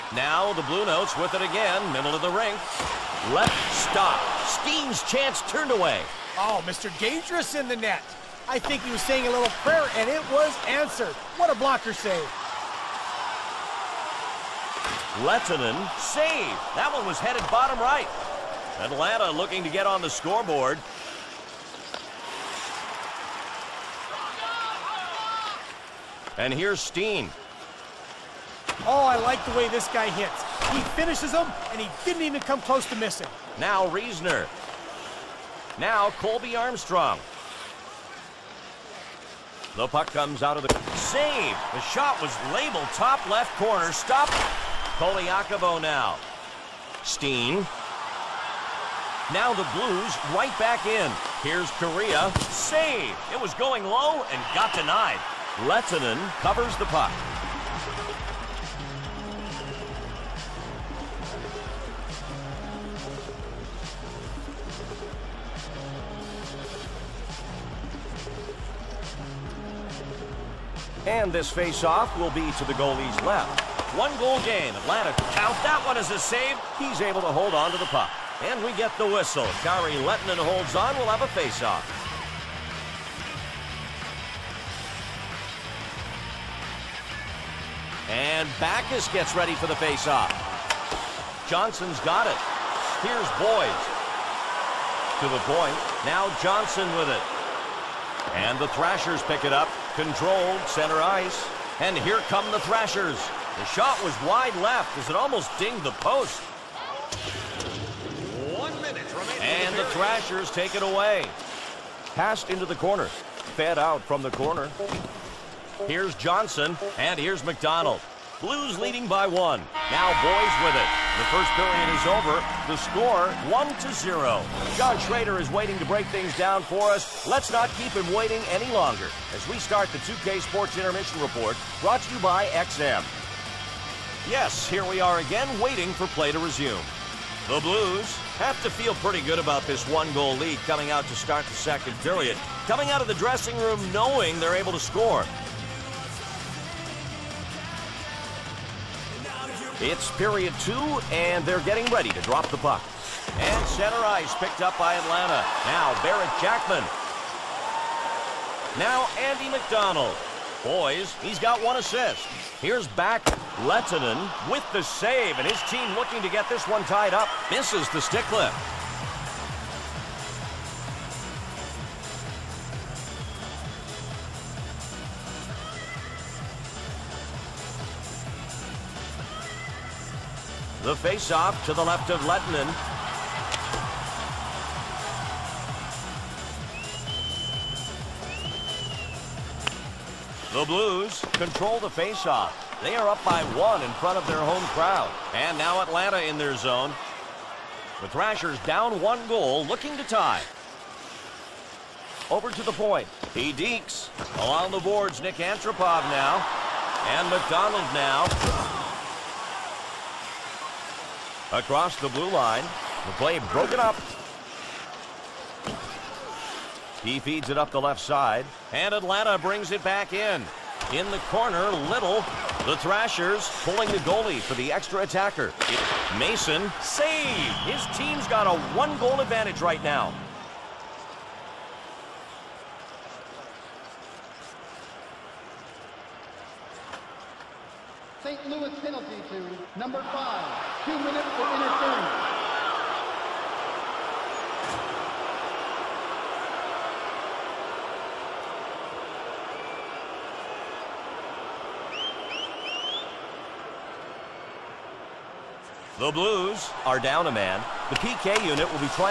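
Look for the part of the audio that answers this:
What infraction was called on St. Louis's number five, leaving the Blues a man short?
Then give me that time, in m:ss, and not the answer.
4:01.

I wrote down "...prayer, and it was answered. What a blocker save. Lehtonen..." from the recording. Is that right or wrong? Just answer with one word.
right.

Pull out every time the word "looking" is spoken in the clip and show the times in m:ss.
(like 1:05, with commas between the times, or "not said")
0:19, 2:45, 3:19.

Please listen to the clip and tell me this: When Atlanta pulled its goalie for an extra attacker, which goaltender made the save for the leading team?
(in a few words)
Mason.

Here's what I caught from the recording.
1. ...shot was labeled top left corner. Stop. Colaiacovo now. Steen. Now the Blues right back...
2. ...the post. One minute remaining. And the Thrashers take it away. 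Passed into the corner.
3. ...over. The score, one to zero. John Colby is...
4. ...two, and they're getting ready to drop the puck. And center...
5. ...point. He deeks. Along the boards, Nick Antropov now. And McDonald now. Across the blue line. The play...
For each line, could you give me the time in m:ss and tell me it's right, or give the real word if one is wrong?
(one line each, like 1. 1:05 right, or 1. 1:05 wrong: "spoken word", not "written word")
1. 0:41 right
2. 1:45 right
3. 2:02 wrong: "Schrader", not "Colby"
4. 2:30 right
5. 3:22 right.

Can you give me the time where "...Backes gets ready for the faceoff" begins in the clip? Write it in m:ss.
1:28.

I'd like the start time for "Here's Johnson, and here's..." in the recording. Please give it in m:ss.
1:55.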